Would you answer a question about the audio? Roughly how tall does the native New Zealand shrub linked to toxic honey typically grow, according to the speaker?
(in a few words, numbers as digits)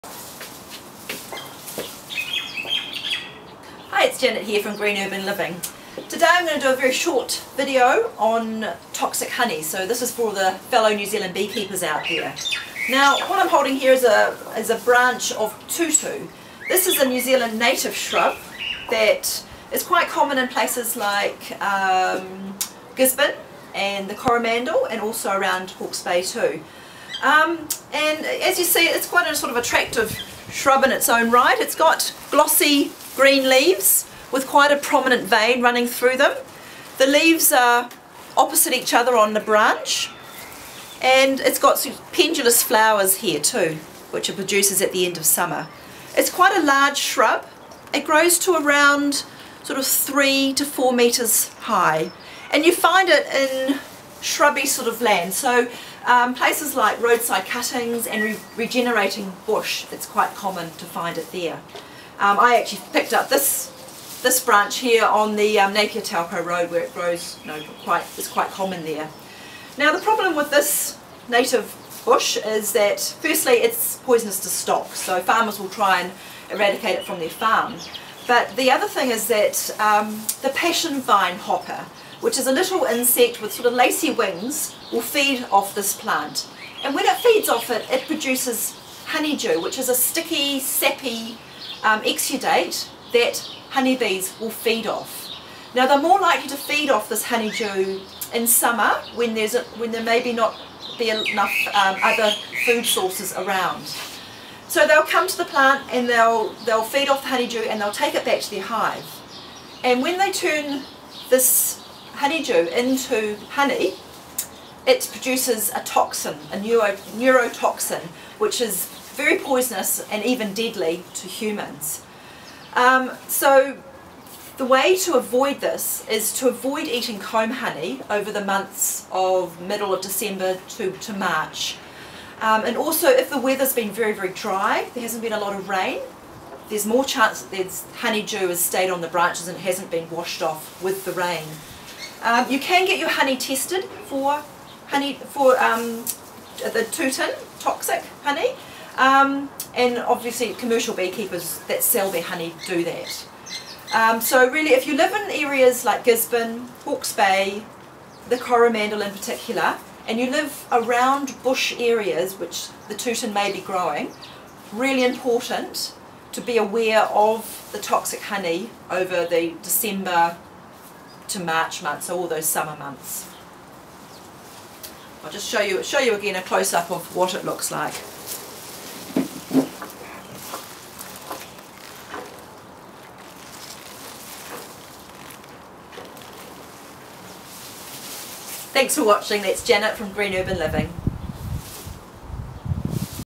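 3 to 4 meters.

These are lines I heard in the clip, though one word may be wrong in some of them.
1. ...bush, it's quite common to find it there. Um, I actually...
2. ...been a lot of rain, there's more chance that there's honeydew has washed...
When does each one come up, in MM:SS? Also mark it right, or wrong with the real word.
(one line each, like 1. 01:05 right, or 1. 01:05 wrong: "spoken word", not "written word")
1. 00:59 right
2. 02:15 wrong: "stayed", not "washed".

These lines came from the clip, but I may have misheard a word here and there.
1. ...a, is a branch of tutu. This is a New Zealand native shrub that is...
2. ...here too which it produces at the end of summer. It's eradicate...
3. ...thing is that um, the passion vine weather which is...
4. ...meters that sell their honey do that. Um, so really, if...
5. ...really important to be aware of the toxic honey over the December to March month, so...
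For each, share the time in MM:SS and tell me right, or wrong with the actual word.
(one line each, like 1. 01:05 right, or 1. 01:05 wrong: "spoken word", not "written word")
1. 00:14 right
2. 00:43 wrong: "quite", not "eradicate"
3. 01:18 wrong: "hopper", not "weather"
4. 02:30 wrong: "beekeepers", not "meters"
5. 02:44 right.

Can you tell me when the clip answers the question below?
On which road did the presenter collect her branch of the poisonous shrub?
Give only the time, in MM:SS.
01:05.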